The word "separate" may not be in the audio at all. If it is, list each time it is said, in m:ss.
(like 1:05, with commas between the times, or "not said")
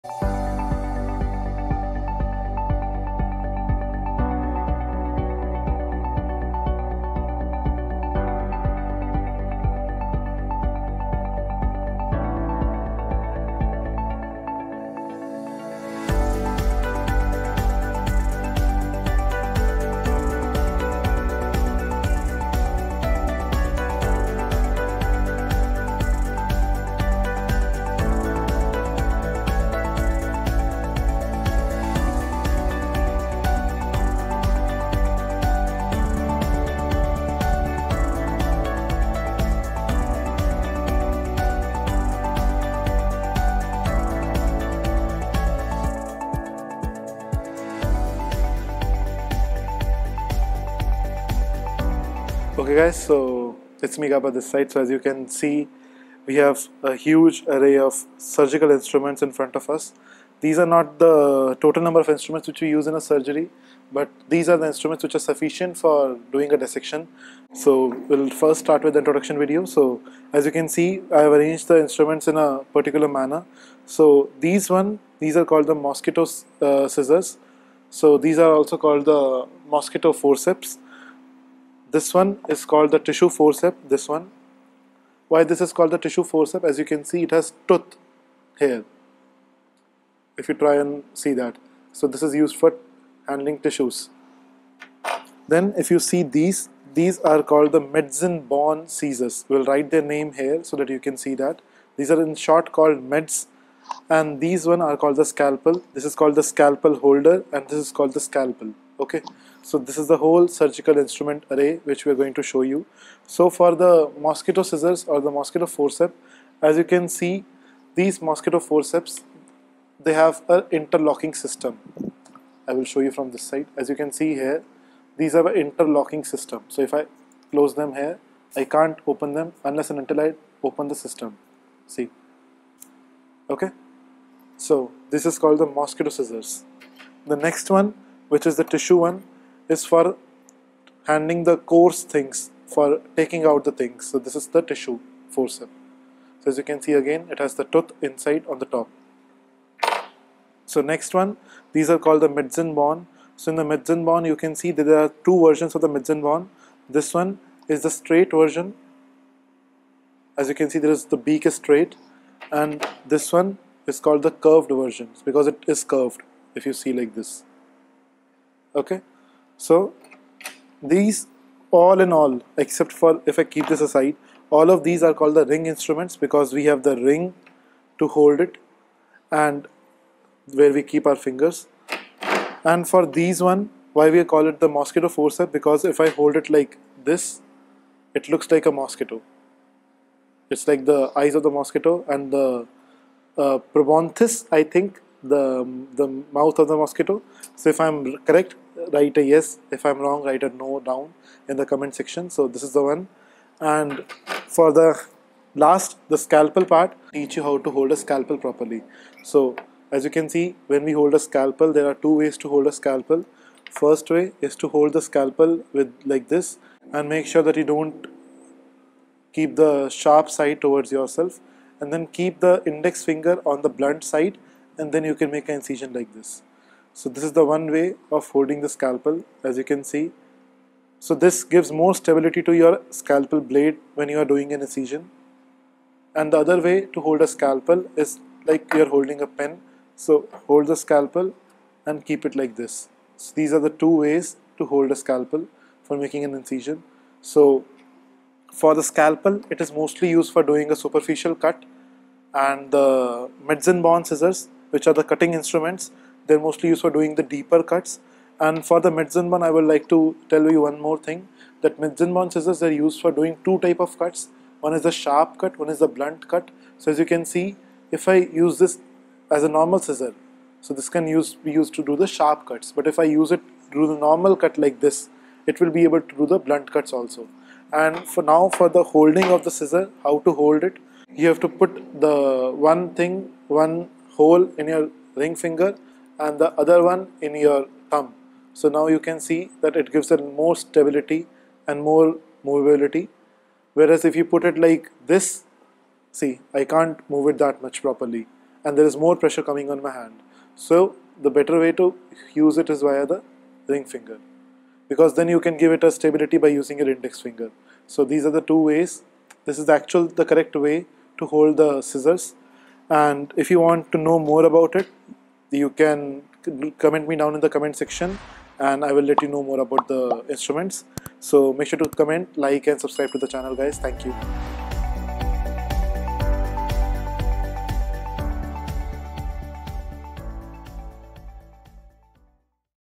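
not said.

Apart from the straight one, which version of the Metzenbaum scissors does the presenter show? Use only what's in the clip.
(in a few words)
Curved version.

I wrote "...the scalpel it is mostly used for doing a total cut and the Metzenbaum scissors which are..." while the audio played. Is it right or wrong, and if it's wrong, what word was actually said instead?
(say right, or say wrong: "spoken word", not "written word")
wrong: "superficial", not "total".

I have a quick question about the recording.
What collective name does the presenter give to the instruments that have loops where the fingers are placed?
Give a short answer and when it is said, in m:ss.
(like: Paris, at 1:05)
Ring instruments, at 2:55.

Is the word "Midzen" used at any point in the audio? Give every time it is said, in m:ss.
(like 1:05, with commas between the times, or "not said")
2:32.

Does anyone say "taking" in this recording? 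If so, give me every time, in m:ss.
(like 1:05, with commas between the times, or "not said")
2:23.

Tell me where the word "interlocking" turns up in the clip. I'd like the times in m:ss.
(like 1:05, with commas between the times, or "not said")
2:00, 2:05.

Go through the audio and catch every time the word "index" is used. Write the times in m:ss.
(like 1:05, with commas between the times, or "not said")
3:42, 5:06.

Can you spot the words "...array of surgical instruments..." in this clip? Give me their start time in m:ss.
0:57.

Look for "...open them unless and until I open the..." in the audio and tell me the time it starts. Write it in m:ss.
2:09.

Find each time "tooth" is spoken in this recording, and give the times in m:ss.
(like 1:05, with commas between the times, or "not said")
1:27, 2:27.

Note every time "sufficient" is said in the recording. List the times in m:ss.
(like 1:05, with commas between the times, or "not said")
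1:05.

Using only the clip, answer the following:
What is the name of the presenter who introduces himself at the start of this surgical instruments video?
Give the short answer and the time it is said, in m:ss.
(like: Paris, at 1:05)
Gaba, at 0:54.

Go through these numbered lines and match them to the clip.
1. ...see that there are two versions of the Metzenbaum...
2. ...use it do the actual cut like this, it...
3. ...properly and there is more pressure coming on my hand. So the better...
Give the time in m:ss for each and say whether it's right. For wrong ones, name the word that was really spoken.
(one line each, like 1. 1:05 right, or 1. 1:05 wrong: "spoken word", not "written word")
1. 2:34 right
2. 4:33 wrong: "normal", not "actual"
3. 4:57 right.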